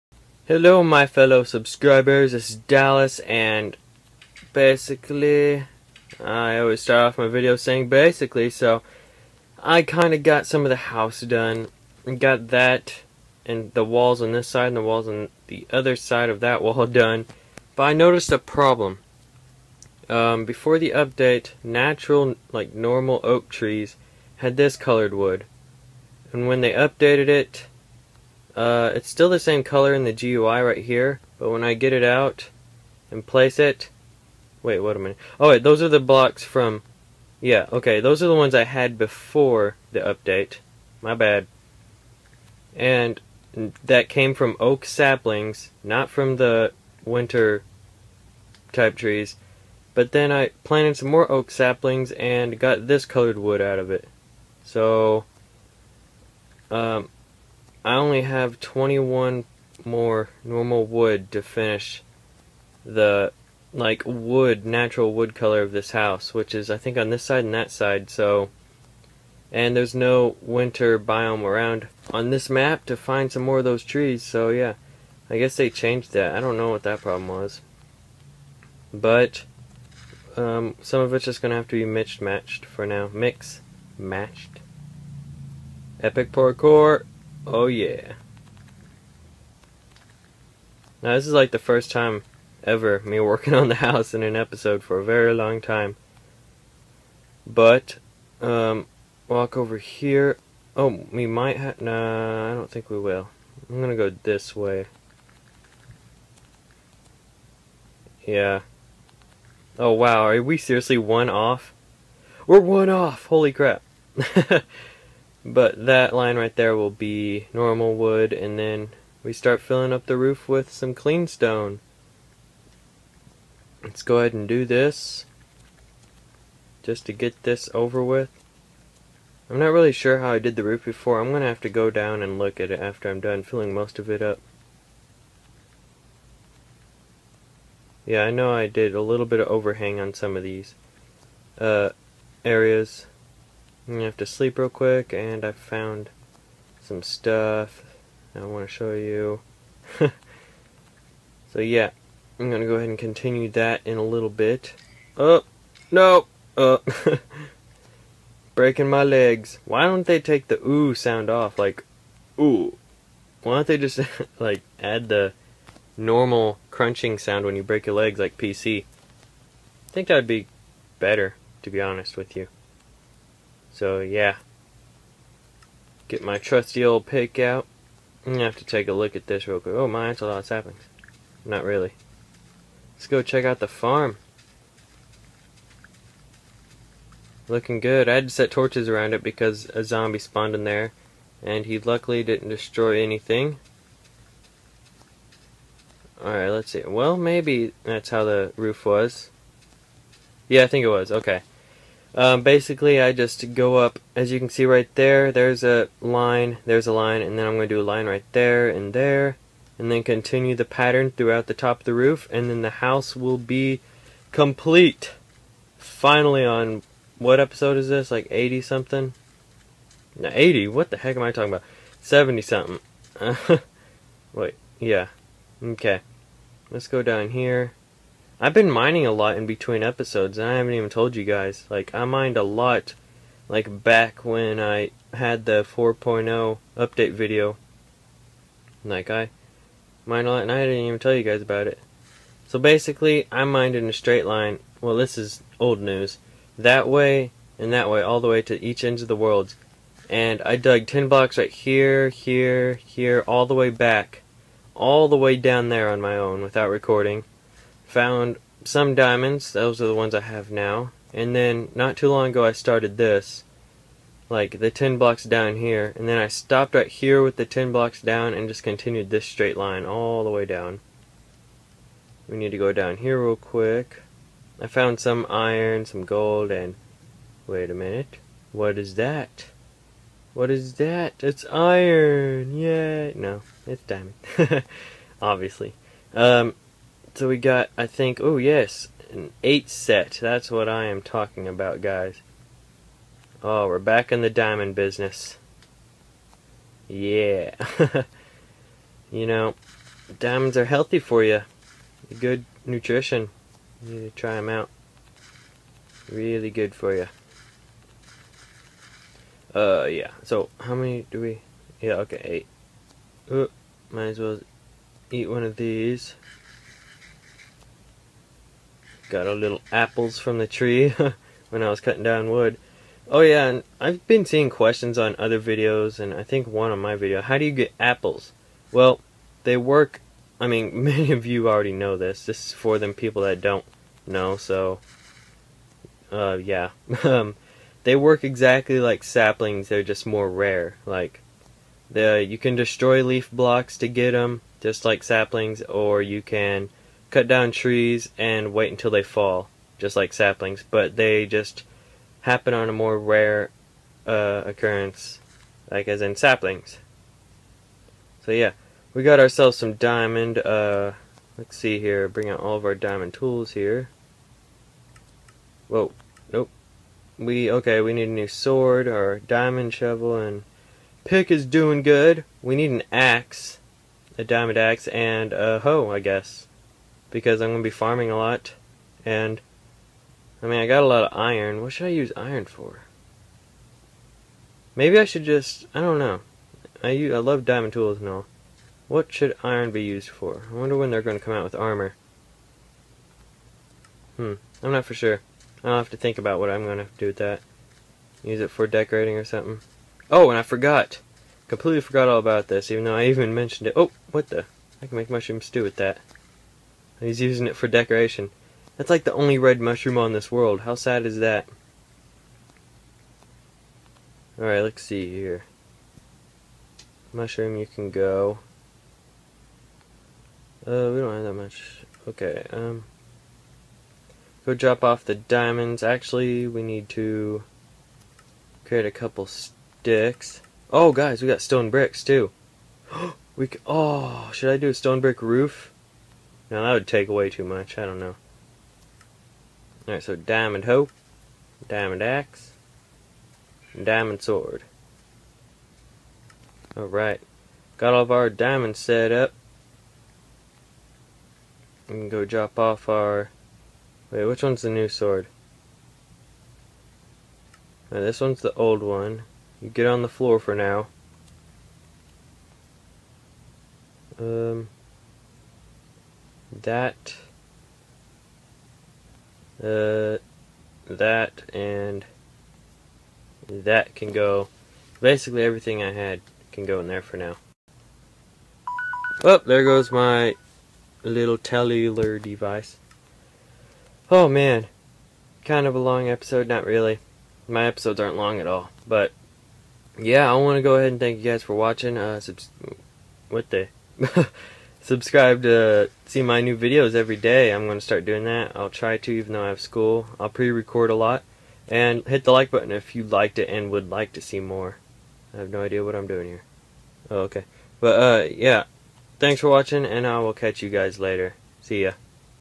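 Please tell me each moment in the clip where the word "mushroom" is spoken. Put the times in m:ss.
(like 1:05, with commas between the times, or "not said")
6:45, 6:49, 6:57.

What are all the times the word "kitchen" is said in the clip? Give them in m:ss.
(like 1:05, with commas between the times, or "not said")
not said.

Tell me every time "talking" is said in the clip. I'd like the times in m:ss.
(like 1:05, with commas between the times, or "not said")
3:41, 4:51.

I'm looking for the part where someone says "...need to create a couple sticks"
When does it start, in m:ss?
7:06.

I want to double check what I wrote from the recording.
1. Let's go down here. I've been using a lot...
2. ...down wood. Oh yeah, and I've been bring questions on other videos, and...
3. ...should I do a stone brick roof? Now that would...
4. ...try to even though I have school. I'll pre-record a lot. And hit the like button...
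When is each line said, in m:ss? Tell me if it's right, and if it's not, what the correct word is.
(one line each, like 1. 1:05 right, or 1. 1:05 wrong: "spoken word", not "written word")
1. 3:46 wrong: "mining", not "using"
2. 5:22 wrong: "seeing", not "bring"
3. 7:14 right
4. 8:18 right.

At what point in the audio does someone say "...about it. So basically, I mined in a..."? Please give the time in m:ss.
4:01.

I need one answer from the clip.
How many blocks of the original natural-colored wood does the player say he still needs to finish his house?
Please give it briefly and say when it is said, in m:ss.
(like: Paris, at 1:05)
21, at 0:58.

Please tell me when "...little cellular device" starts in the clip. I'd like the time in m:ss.
8:01.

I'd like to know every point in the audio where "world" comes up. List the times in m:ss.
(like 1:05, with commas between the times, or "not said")
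4:09, 6:50.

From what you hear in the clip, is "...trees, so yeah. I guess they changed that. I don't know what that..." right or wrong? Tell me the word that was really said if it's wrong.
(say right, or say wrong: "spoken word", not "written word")
right.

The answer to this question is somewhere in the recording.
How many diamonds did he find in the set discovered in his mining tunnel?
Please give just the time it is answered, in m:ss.
4:49.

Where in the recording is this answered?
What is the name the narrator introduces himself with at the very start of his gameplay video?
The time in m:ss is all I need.
0:02.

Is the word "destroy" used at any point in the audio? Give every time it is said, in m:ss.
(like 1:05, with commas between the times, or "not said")
3:12, 5:42.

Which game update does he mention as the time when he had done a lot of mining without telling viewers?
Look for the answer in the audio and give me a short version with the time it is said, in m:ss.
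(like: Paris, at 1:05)
4.0 update, at 3:55.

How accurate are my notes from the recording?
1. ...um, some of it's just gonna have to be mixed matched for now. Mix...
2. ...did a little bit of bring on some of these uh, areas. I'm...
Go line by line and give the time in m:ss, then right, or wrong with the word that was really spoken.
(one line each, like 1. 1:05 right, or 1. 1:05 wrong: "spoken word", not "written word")
1. 1:20 right
2. 2:18 wrong: "overhang", not "bring".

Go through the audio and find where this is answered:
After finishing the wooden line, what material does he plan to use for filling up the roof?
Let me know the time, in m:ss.
2:00.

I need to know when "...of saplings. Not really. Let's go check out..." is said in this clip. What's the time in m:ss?
3:00.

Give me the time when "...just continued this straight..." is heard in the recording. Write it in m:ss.
4:28.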